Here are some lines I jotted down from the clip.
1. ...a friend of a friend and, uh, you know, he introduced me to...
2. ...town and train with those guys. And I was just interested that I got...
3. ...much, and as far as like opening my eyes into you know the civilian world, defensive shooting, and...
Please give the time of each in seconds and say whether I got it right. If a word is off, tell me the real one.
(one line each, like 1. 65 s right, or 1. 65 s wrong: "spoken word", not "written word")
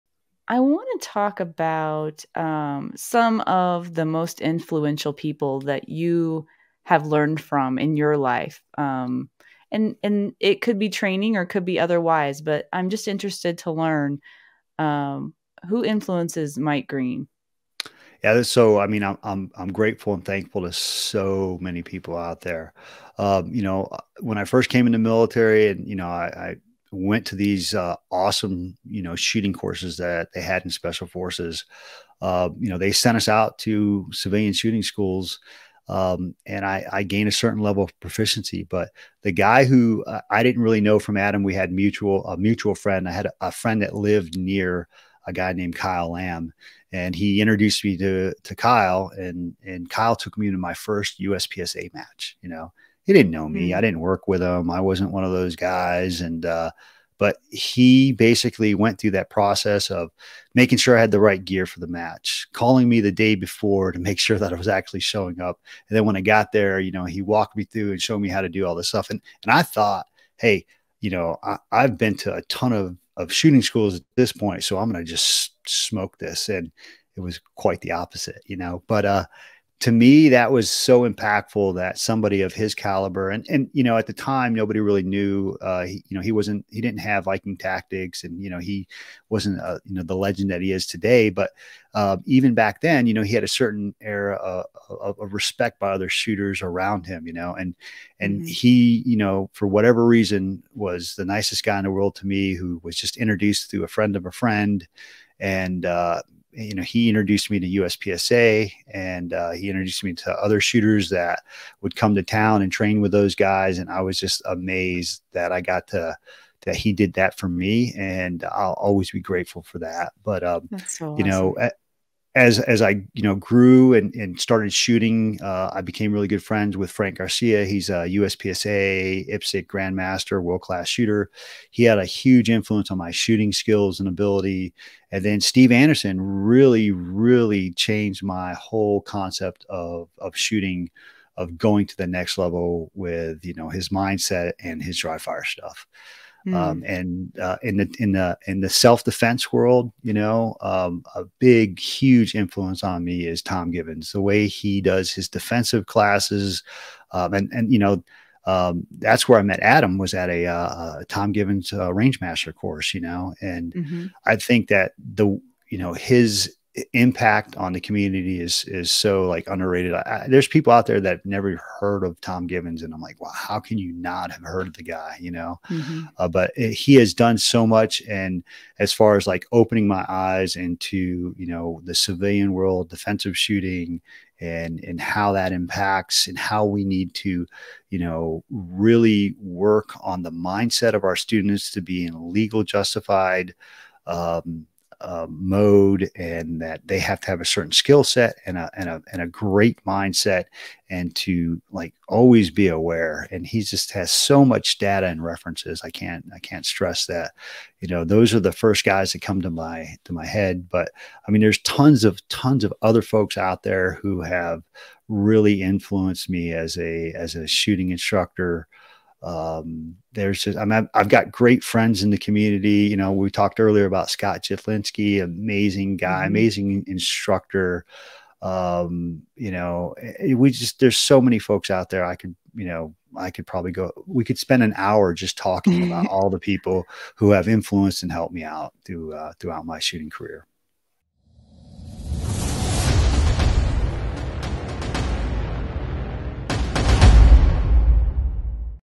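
1. 103 s right
2. 112 s wrong: "amazed", not "interested"
3. 177 s right.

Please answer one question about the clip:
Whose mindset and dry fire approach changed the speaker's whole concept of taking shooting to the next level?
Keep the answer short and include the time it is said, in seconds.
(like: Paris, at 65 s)
Steve Anderson, at 135 s.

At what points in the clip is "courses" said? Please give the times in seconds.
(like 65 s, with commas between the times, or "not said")
29 s, 162 s.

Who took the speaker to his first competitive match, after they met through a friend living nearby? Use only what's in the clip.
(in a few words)
Kyle Lamb.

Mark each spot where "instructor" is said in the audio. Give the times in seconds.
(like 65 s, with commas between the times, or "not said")
217 s, 226 s.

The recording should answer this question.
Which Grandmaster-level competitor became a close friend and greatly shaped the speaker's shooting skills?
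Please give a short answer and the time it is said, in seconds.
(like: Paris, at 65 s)
Frank Garcia, at 126 s.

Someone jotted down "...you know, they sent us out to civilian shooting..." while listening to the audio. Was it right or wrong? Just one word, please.
right.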